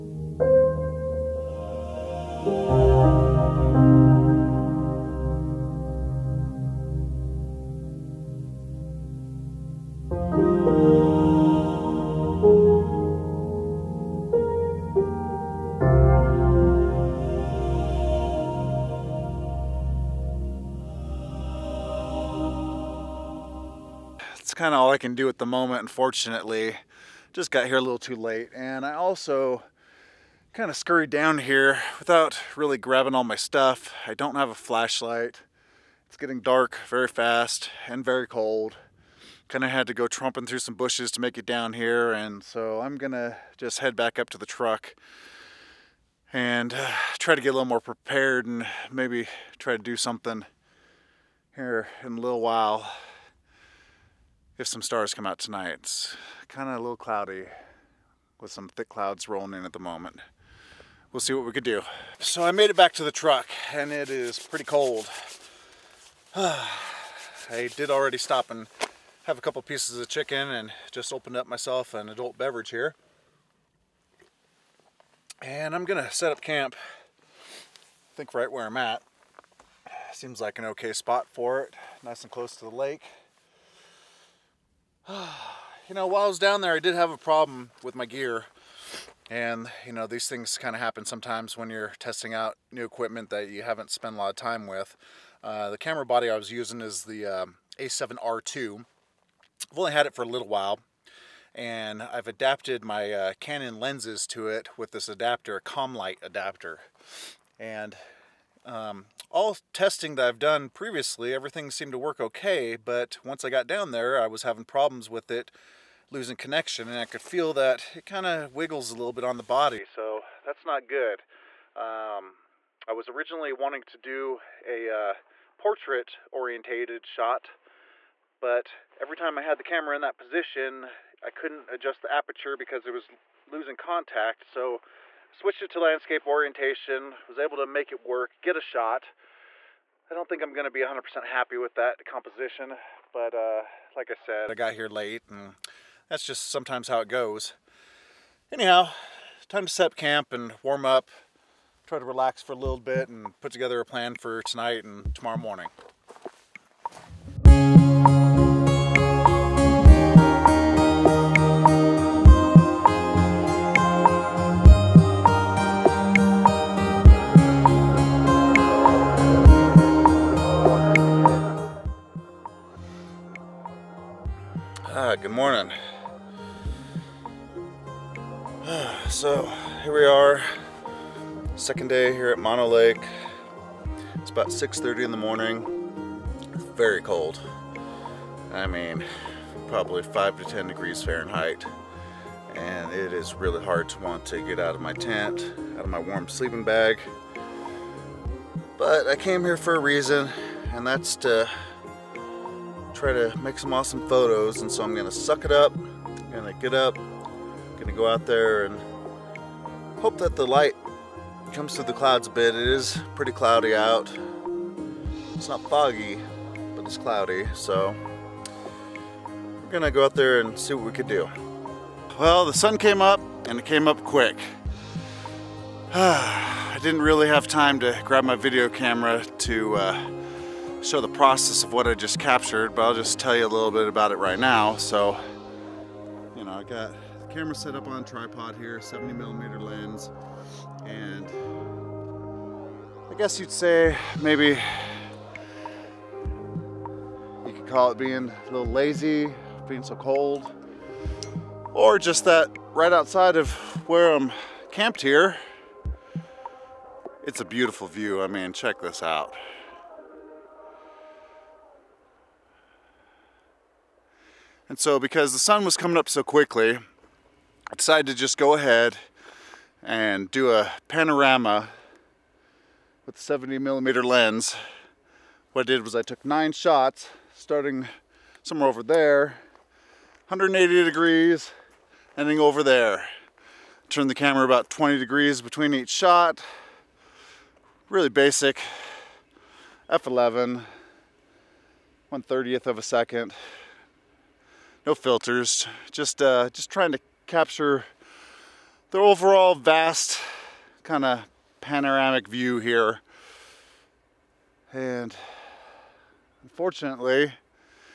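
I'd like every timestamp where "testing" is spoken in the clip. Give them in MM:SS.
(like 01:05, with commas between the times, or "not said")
01:31, 01:49.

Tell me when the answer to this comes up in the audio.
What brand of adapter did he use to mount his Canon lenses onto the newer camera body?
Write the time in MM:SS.
01:45.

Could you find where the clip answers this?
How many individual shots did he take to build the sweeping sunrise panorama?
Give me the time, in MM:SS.
04:36.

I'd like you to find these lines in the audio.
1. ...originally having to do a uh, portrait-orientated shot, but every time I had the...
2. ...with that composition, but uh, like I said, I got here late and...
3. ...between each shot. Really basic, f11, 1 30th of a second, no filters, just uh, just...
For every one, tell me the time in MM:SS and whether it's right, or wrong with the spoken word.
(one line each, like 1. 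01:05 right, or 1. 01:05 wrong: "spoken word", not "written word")
1. 02:03 wrong: "wanting", not "having"
2. 02:21 right
3. 04:45 right.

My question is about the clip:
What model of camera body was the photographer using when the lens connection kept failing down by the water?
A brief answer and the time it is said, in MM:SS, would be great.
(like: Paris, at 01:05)
A7R2, at 01:37.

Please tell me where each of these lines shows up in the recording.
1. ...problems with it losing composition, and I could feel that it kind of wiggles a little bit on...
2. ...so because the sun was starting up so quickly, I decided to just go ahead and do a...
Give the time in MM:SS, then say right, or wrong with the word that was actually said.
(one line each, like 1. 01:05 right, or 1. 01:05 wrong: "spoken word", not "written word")
1. 01:54 wrong: "connection", not "composition"
2. 04:24 wrong: "coming", not "starting".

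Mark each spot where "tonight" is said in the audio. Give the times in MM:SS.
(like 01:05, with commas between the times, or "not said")
00:55, 02:34.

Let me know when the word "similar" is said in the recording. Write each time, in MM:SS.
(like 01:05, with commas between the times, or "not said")
not said.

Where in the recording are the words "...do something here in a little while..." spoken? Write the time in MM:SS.
00:49.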